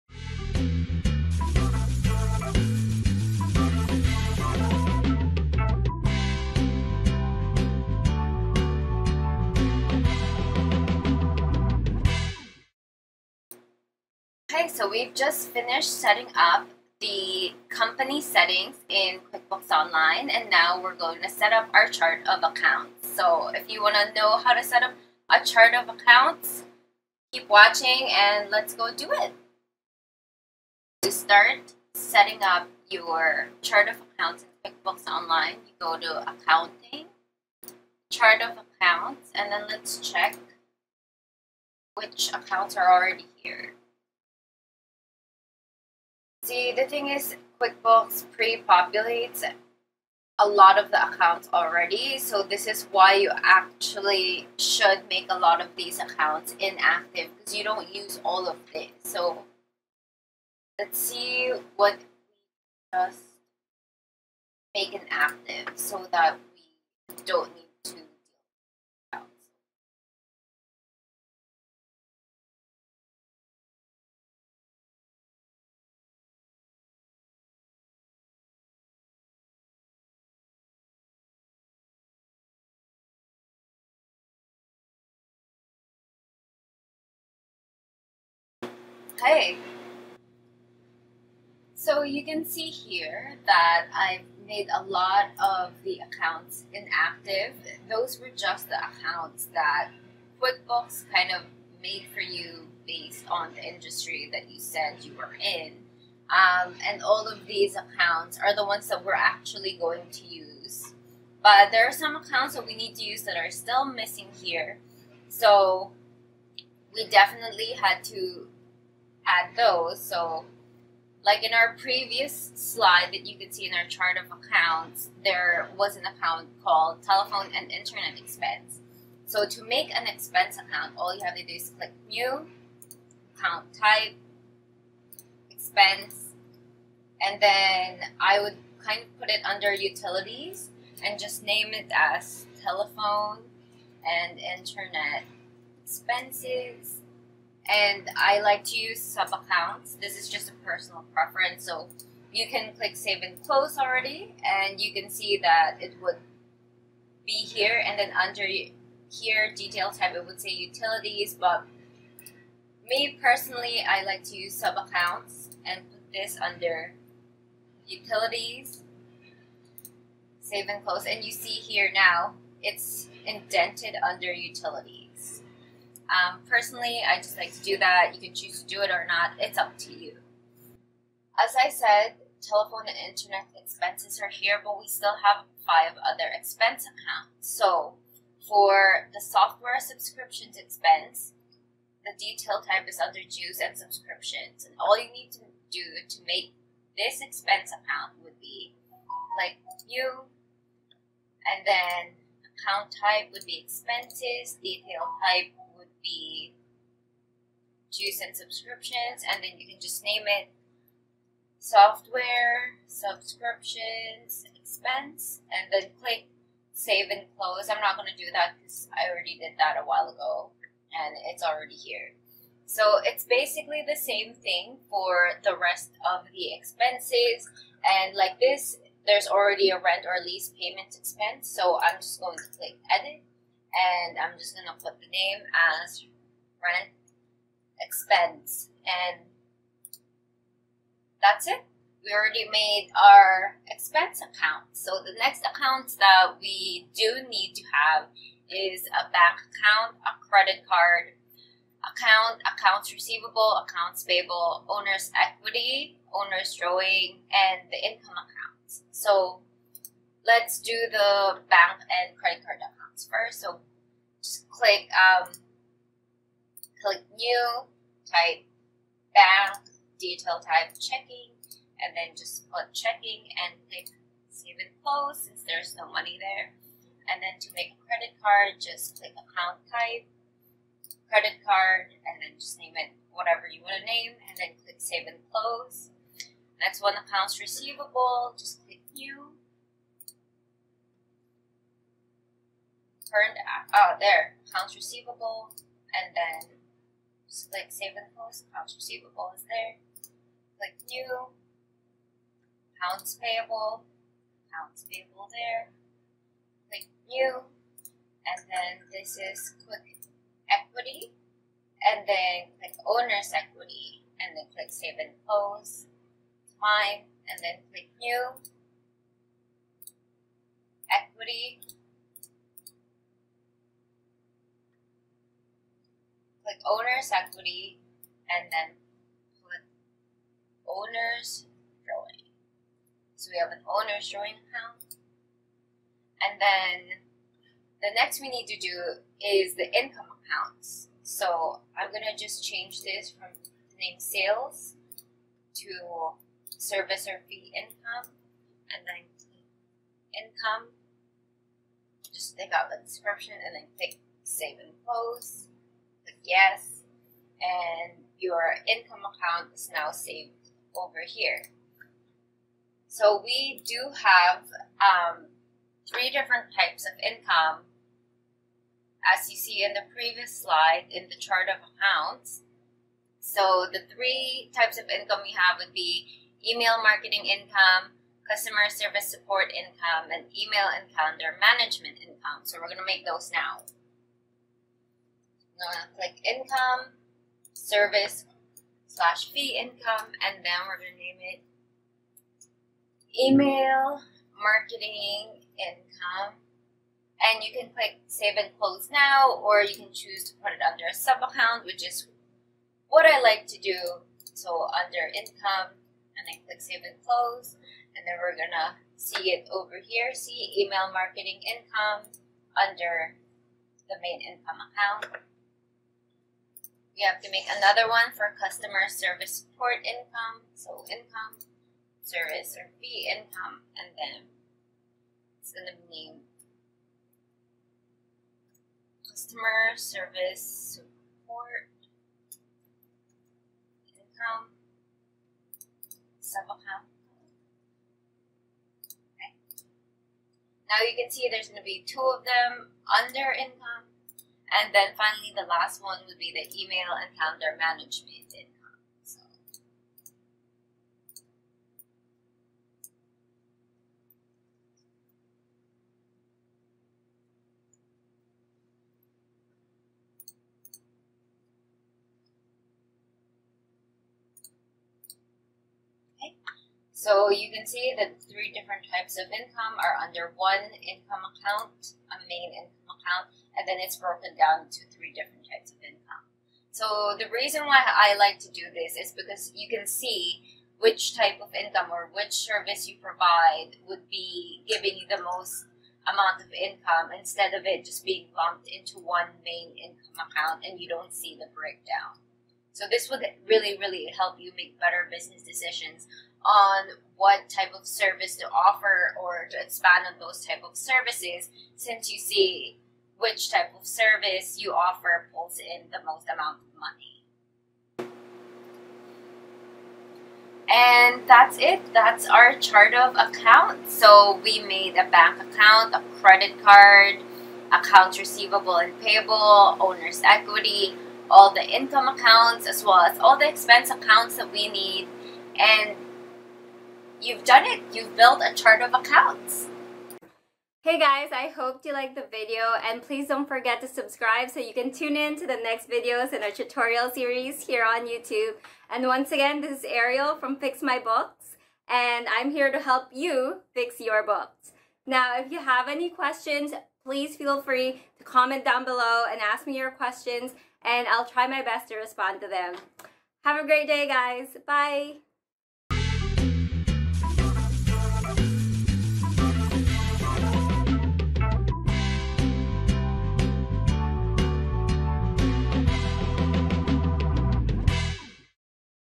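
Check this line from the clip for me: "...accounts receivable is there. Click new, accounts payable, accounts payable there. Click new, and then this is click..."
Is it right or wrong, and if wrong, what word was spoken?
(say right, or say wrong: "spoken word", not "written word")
right.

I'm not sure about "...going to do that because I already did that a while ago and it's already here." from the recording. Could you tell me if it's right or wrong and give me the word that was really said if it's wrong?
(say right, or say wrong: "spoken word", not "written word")
right.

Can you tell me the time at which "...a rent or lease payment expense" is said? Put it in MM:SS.
03:49.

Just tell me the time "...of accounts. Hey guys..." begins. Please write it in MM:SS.
08:48.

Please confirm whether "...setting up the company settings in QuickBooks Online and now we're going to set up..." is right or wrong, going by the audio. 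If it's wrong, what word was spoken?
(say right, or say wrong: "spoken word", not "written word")
right.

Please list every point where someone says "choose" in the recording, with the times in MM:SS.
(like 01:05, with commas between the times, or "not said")
02:58, 06:39.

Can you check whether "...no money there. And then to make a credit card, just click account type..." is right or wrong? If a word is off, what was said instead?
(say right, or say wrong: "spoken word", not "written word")
right.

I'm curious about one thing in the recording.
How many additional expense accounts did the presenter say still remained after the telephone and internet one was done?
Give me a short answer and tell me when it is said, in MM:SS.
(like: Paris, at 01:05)
5, at 03:05.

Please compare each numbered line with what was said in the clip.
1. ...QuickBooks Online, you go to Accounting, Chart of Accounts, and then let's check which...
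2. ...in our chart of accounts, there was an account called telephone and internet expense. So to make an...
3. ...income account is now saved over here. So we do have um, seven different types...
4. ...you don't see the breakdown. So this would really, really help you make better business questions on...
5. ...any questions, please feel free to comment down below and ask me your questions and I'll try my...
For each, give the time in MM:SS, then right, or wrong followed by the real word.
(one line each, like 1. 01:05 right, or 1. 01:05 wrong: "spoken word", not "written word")
1. 00:34 right
2. 02:03 right
3. 05:58 wrong: "three", not "seven"
4. 08:10 wrong: "decisions", not "questions"
5. 09:05 right.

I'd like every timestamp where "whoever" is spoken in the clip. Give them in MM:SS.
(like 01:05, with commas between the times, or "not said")
not said.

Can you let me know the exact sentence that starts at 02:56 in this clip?
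Um, personally, I just like to do that.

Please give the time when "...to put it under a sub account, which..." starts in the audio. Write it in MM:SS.
06:40.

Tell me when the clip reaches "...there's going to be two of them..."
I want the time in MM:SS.
07:21.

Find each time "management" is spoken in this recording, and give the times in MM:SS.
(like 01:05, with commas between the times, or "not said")
06:21, 07:27.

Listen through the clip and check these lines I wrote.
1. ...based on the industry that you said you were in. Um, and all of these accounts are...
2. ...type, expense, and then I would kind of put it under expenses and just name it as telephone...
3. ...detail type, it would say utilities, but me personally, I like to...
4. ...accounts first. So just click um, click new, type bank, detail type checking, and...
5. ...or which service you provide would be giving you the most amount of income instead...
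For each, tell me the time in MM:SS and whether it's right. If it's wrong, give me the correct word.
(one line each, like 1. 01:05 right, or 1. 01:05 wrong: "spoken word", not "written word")
1. 01:42 right
2. 02:13 wrong: "utilities", not "expenses"
3. 02:39 right
4. 04:22 right
5. 08:01 right.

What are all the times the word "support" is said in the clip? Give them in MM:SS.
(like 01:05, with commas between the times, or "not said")
06:19, 06:59, 07:10.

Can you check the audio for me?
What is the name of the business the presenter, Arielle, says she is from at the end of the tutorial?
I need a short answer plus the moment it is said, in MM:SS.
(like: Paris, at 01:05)
Fix My Books, at 09:00.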